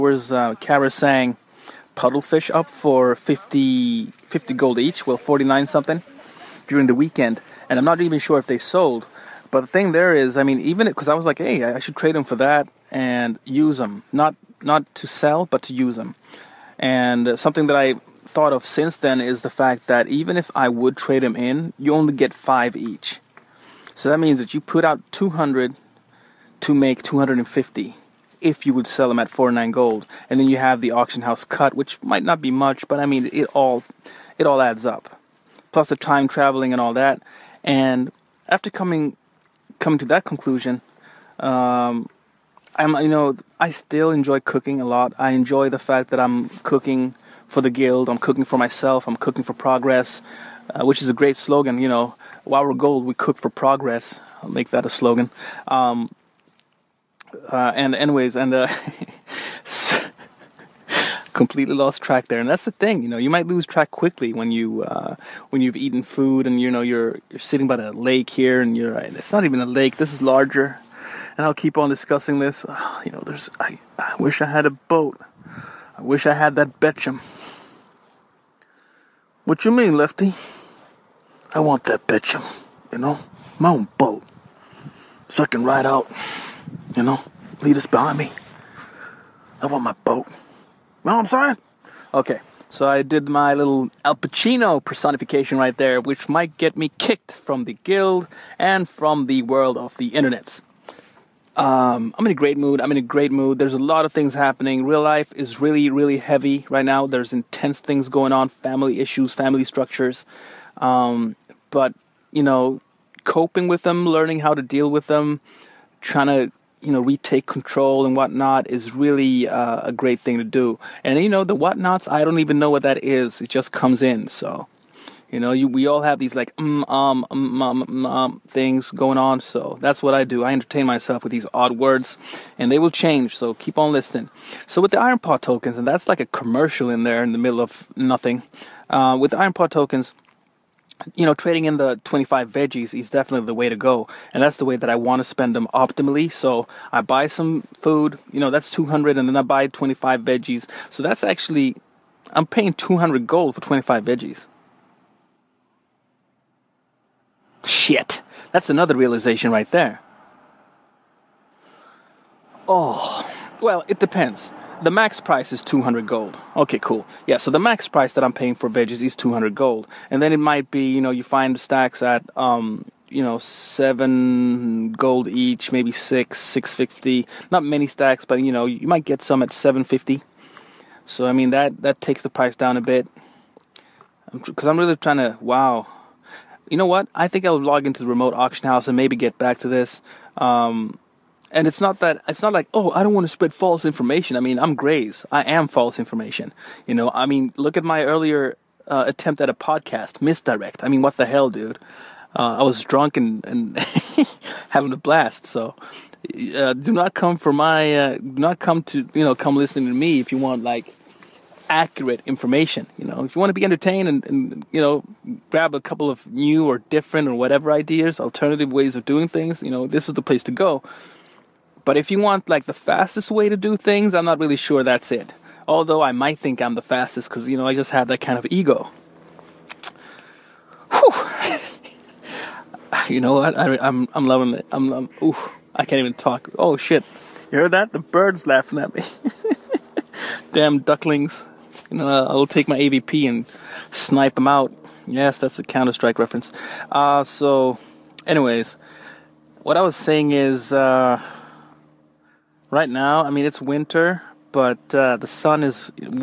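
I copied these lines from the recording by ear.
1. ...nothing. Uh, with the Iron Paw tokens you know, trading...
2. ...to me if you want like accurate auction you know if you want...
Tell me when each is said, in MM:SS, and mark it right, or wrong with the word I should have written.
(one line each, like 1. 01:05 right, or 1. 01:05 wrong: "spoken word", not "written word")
1. 02:17 right
2. 03:29 wrong: "information", not "auction".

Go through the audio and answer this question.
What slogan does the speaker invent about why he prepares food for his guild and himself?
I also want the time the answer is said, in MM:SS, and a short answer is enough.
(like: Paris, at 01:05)
We cook for progress, at 00:53.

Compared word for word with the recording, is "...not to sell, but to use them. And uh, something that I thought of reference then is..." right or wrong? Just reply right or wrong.
wrong.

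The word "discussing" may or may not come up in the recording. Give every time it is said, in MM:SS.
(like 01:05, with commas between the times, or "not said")
01:11.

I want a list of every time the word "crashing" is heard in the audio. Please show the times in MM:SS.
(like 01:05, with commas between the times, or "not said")
not said.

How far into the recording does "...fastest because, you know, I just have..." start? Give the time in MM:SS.
03:46.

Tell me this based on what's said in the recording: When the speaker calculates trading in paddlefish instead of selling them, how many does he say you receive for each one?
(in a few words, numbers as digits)
5.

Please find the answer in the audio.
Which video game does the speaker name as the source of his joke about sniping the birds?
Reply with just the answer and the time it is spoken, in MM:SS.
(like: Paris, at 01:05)
Counter Strike, at 04:05.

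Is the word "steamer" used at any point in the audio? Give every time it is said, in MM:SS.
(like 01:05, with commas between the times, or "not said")
not said.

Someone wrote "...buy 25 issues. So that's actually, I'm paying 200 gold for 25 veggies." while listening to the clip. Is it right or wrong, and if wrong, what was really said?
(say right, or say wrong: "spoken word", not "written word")
wrong: "veggies", not "issues".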